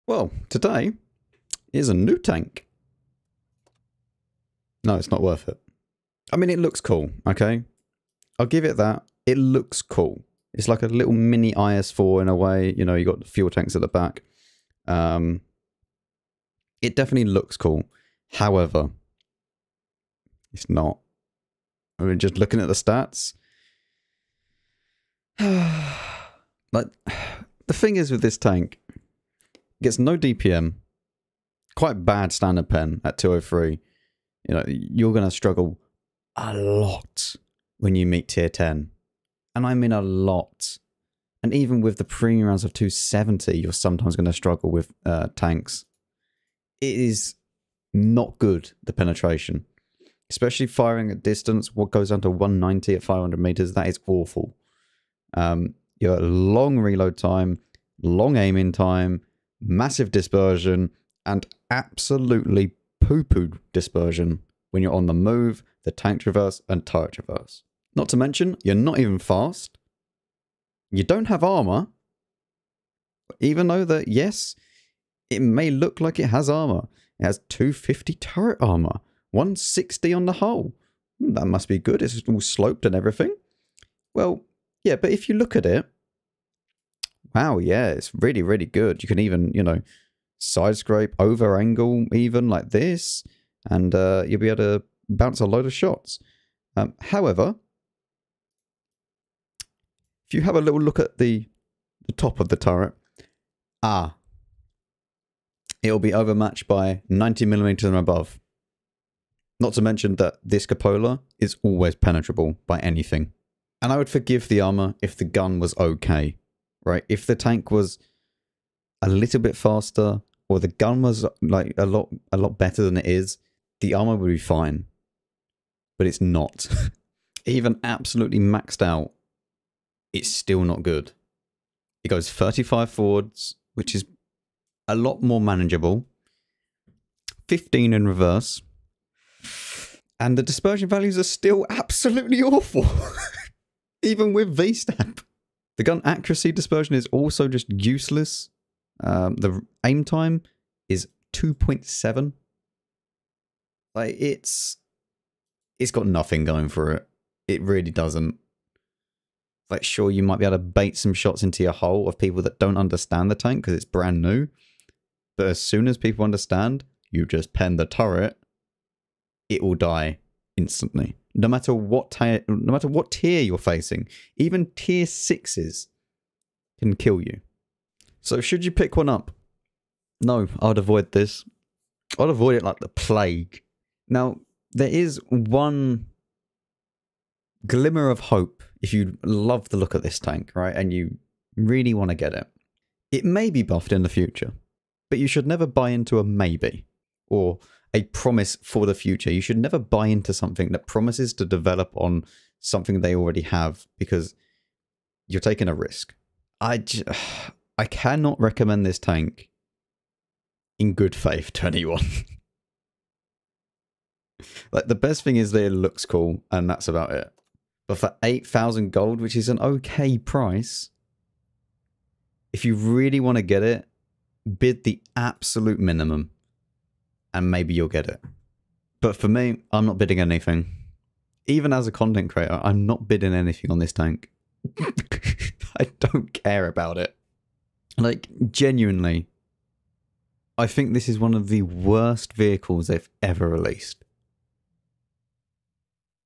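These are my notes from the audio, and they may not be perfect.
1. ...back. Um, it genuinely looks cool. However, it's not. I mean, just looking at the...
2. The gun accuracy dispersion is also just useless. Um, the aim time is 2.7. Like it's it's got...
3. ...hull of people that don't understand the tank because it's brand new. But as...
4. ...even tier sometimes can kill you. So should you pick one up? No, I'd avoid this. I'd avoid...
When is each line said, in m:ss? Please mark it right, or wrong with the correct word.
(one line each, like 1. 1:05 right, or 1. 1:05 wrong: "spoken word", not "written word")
1. 0:13 wrong: "definitely", not "genuinely"
2. 2:25 right
3. 2:41 right
4. 2:54 wrong: "sixes", not "sometimes".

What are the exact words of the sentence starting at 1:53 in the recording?
And I would forgive the armor if the gun was okay right?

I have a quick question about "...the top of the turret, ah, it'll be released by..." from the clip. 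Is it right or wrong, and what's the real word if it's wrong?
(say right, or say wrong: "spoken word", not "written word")
wrong: "overmatched", not "released".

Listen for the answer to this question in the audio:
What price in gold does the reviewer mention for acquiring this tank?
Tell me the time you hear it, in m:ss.
3:38.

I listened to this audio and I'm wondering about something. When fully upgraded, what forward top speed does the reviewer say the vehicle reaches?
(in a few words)
35.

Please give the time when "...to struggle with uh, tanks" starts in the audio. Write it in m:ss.
0:44.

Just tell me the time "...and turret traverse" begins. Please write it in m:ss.
1:06.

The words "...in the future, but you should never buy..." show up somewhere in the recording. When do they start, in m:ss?
3:13.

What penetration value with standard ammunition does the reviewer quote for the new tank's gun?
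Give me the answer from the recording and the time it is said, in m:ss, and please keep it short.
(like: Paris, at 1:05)
203, at 0:33.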